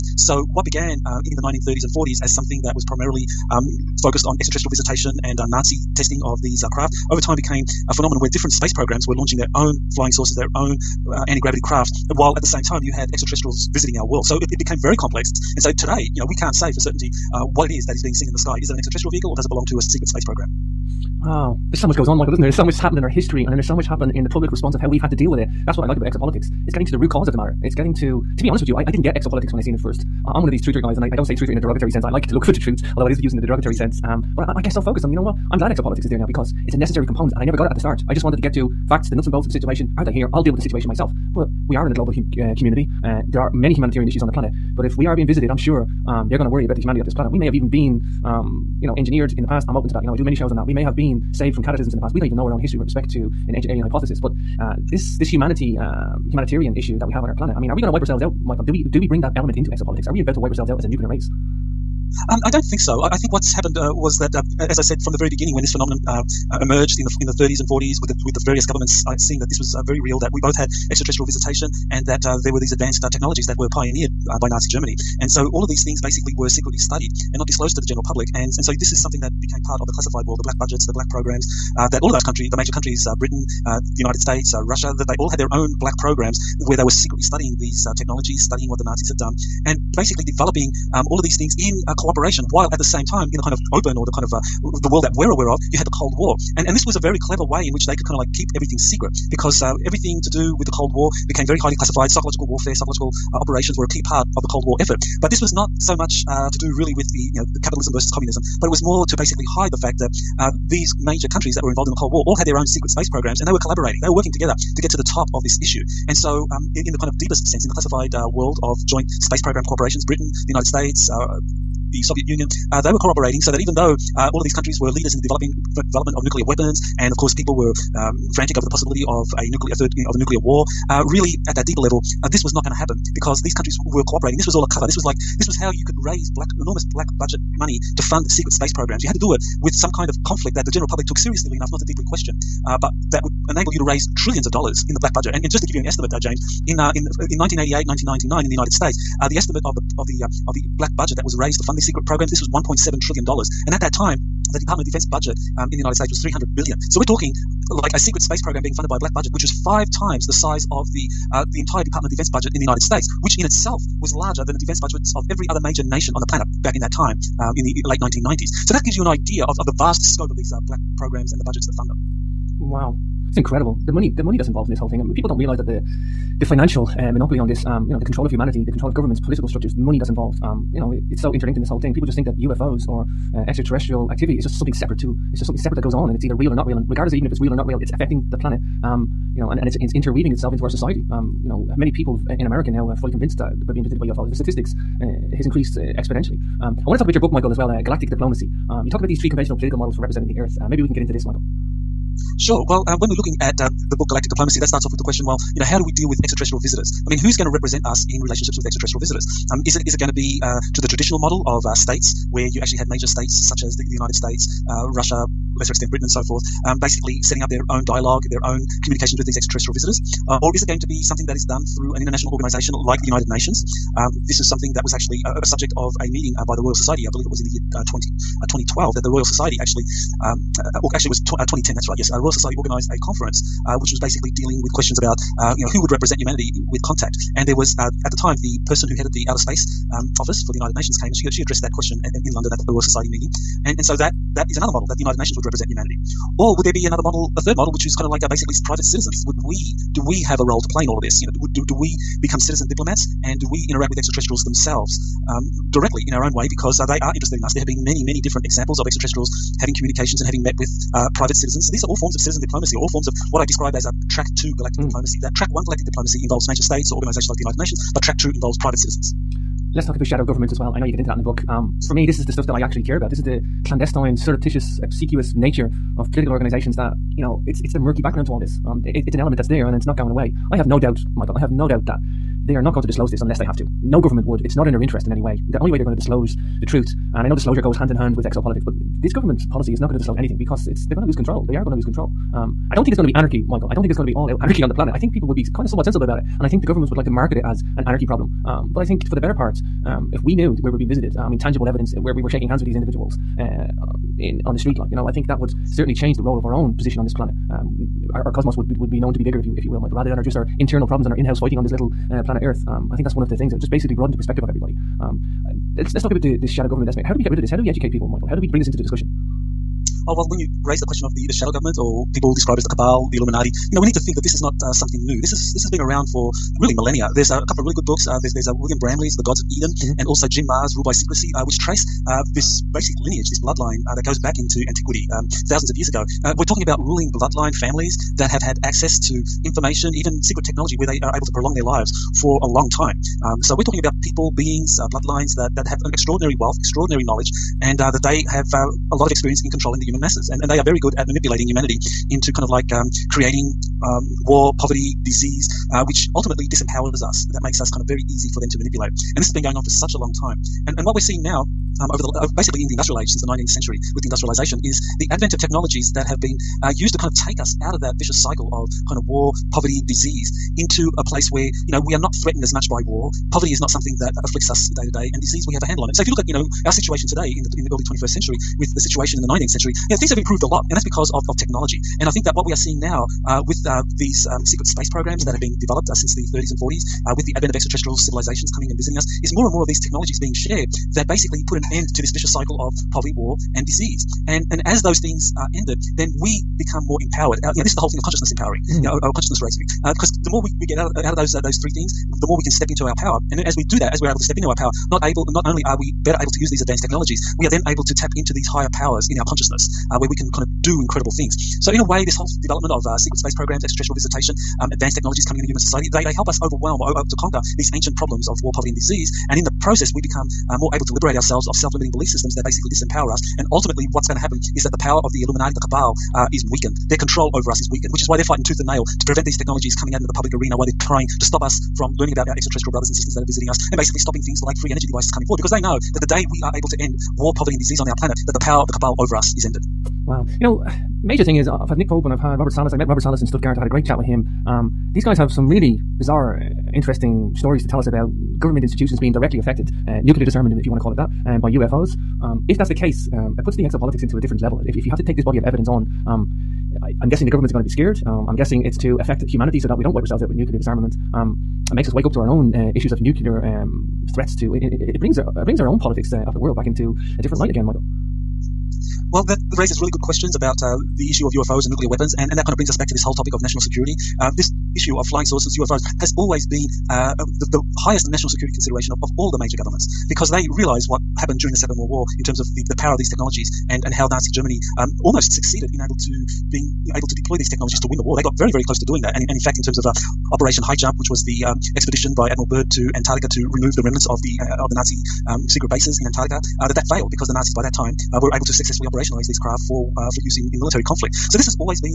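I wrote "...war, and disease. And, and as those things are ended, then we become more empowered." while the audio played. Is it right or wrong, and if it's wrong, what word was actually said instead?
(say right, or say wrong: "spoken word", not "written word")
right.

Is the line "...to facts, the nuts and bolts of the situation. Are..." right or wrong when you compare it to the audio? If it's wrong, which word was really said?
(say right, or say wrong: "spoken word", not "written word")
right.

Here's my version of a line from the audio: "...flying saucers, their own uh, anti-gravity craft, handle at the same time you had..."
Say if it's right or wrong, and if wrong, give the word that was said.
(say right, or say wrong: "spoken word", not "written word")
wrong: "while", not "handle".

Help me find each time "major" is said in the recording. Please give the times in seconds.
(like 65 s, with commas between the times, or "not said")
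82 s, 110 s, 165 s, 212 s, 266 s, 441 s, 479 s.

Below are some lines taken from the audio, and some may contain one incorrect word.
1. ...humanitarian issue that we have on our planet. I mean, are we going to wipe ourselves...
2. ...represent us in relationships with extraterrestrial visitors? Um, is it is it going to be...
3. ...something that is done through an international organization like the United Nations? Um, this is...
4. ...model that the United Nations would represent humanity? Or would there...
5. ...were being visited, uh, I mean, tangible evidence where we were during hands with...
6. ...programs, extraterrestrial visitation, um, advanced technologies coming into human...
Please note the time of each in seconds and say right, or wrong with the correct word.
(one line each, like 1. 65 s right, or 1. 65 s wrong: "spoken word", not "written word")
1. 56 s right
2. 207 s right
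3. 221 s right
4. 244 s right
5. 300 s wrong: "shaking", not "during"
6. 413 s right.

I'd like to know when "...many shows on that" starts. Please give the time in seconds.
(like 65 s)
50 s.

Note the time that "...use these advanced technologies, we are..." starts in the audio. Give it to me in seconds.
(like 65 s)
406 s.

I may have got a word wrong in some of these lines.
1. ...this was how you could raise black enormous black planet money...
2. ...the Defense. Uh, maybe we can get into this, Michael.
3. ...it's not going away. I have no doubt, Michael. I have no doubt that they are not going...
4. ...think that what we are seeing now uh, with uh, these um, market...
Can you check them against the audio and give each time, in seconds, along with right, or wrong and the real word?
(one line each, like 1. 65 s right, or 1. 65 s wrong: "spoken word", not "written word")
1. 135 s wrong: "budget", not "planet"
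2. 200 s wrong: "Earth", not "Defense"
3. 279 s right
4. 382 s wrong: "secret", not "market".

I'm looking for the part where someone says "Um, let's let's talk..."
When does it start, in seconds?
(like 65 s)
314 s.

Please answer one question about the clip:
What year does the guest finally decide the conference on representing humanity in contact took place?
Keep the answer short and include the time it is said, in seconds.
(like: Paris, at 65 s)
2010, at 231 s.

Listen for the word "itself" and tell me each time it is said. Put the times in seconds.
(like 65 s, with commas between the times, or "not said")
163 s, 190 s.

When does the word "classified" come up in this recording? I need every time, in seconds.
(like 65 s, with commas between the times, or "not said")
79 s, 101 s, 117 s.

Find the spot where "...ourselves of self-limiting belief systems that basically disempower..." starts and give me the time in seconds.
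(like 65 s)
421 s.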